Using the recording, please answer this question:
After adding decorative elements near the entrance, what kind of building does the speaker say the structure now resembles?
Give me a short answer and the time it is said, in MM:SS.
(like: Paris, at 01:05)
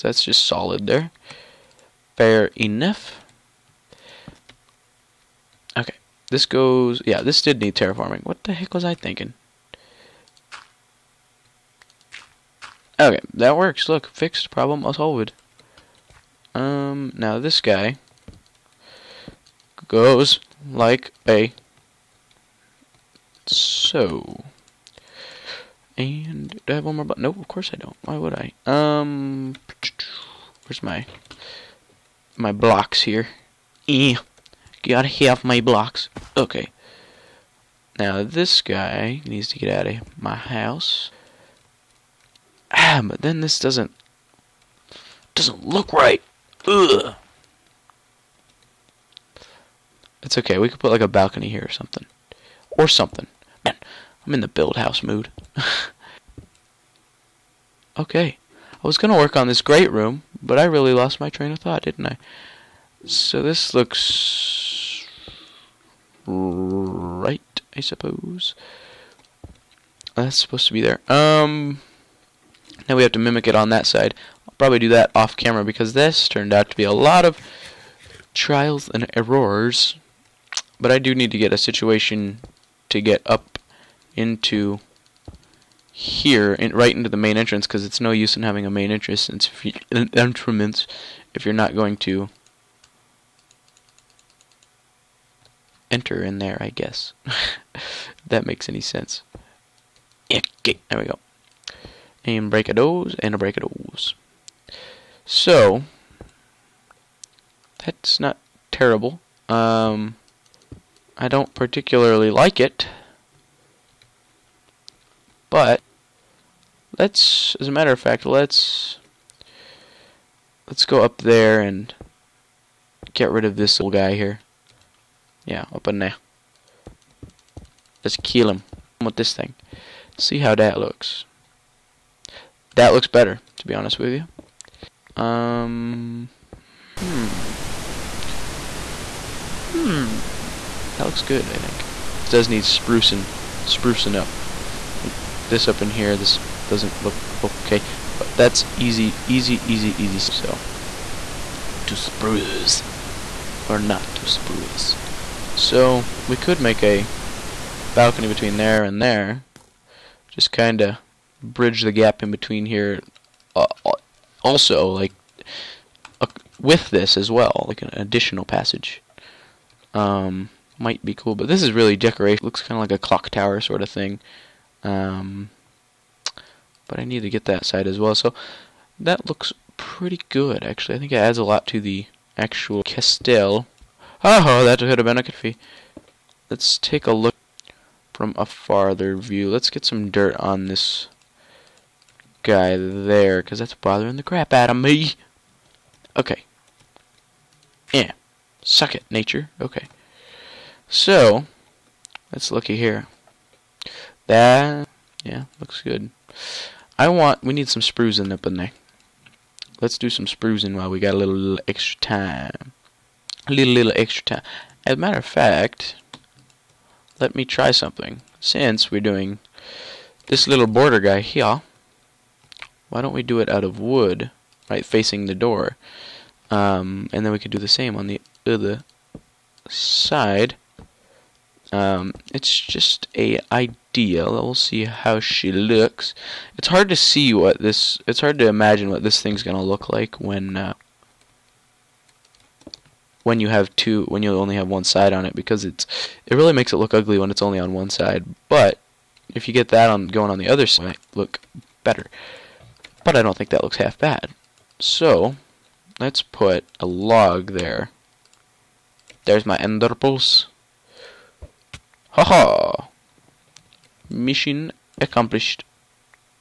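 clock tower, at 02:53.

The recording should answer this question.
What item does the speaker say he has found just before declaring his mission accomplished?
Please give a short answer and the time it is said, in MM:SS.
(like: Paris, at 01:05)
ender pulse, at 04:19.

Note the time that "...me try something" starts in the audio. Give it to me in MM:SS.
03:37.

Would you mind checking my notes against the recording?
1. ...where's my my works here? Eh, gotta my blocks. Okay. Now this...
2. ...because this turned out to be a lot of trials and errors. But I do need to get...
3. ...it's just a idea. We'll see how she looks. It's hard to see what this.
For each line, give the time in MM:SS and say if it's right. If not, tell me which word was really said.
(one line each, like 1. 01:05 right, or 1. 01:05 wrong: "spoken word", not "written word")
1. 00:30 wrong: "blocks", not "works"
2. 01:15 right
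3. 03:52 right.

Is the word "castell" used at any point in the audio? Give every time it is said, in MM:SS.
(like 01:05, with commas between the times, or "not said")
03:02.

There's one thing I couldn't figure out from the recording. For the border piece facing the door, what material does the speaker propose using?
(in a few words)
wood.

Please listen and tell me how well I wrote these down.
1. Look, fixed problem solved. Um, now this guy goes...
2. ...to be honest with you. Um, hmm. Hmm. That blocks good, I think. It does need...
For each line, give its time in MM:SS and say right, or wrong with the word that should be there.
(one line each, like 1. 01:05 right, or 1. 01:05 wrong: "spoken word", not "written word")
1. 00:13 right
2. 02:13 wrong: "looks", not "blocks".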